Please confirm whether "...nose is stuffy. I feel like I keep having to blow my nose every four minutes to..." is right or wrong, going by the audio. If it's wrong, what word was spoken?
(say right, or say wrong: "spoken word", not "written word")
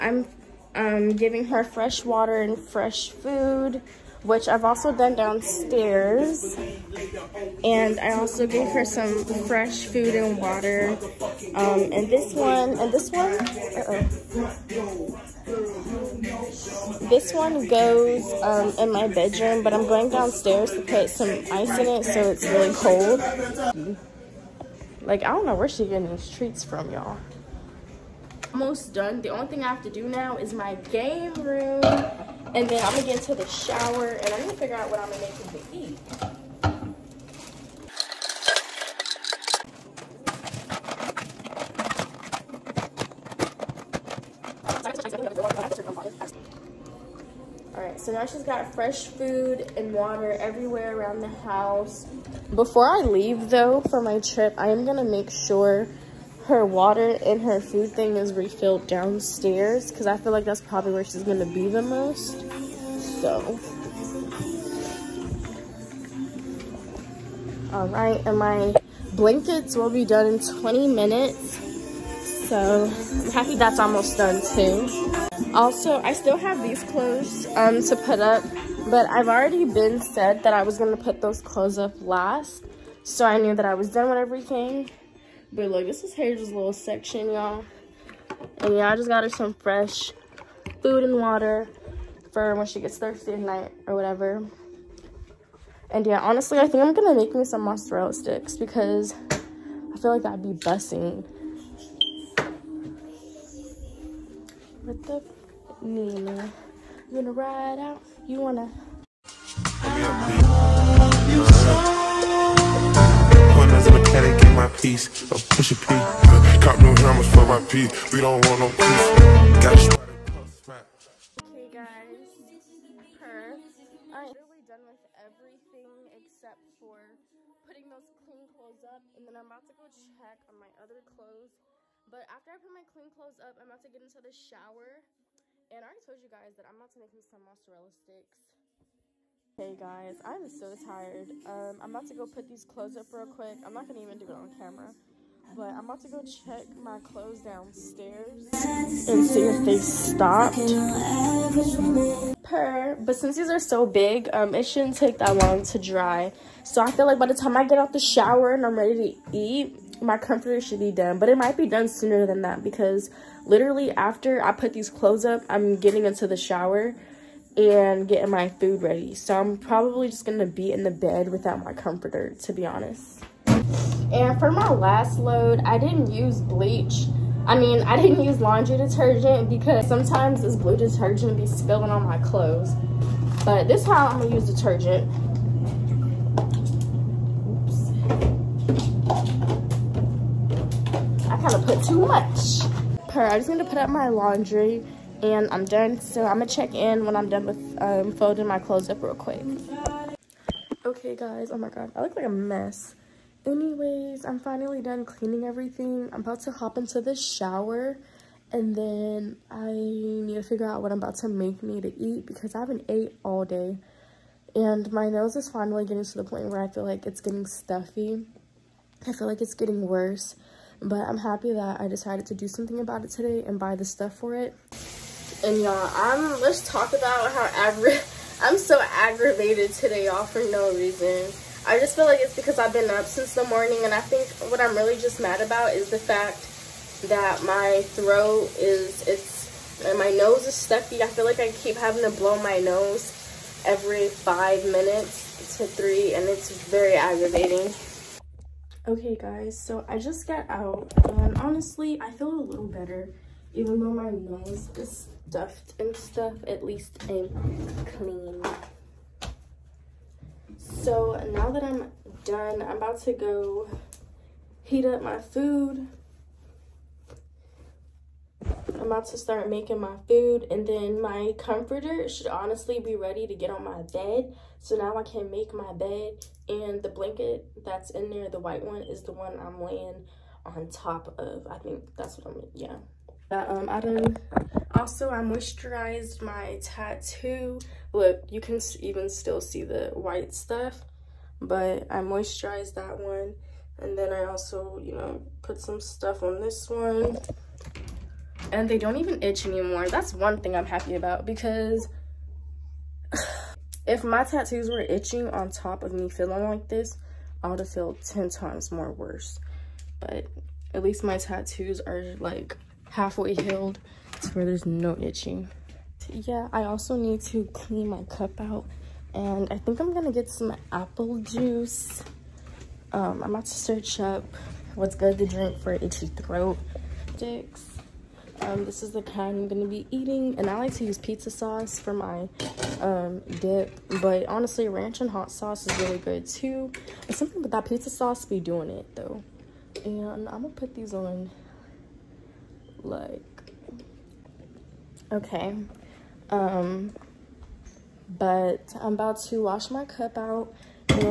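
wrong: "five", not "four".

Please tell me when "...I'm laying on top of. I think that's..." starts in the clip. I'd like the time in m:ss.
4:39.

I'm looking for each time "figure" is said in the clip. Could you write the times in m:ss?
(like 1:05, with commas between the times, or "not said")
0:34, 3:30.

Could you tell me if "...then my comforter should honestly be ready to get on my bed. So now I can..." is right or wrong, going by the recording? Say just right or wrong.
right.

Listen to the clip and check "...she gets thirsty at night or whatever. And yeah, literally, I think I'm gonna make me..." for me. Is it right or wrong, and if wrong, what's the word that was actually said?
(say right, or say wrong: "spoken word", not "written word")
wrong: "honestly", not "literally".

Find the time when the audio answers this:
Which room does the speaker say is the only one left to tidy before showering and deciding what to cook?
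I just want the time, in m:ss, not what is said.
0:30.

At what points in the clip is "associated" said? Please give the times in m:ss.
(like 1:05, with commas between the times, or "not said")
not said.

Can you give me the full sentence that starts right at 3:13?
Per, I'm just gonna put up my laundry and I'm done.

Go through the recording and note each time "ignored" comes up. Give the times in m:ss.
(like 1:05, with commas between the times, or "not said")
not said.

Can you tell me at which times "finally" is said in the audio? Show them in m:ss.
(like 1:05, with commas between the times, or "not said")
3:24, 3:35.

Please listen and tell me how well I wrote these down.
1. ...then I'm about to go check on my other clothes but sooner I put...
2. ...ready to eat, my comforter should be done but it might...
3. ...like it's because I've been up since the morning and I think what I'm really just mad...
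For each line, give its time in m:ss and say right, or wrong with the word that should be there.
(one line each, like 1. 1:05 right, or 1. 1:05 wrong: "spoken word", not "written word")
1. 2:09 wrong: "after", not "sooner"
2. 2:38 right
3. 3:52 right.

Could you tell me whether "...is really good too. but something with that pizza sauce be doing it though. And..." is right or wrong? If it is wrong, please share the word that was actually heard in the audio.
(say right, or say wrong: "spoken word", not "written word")
right.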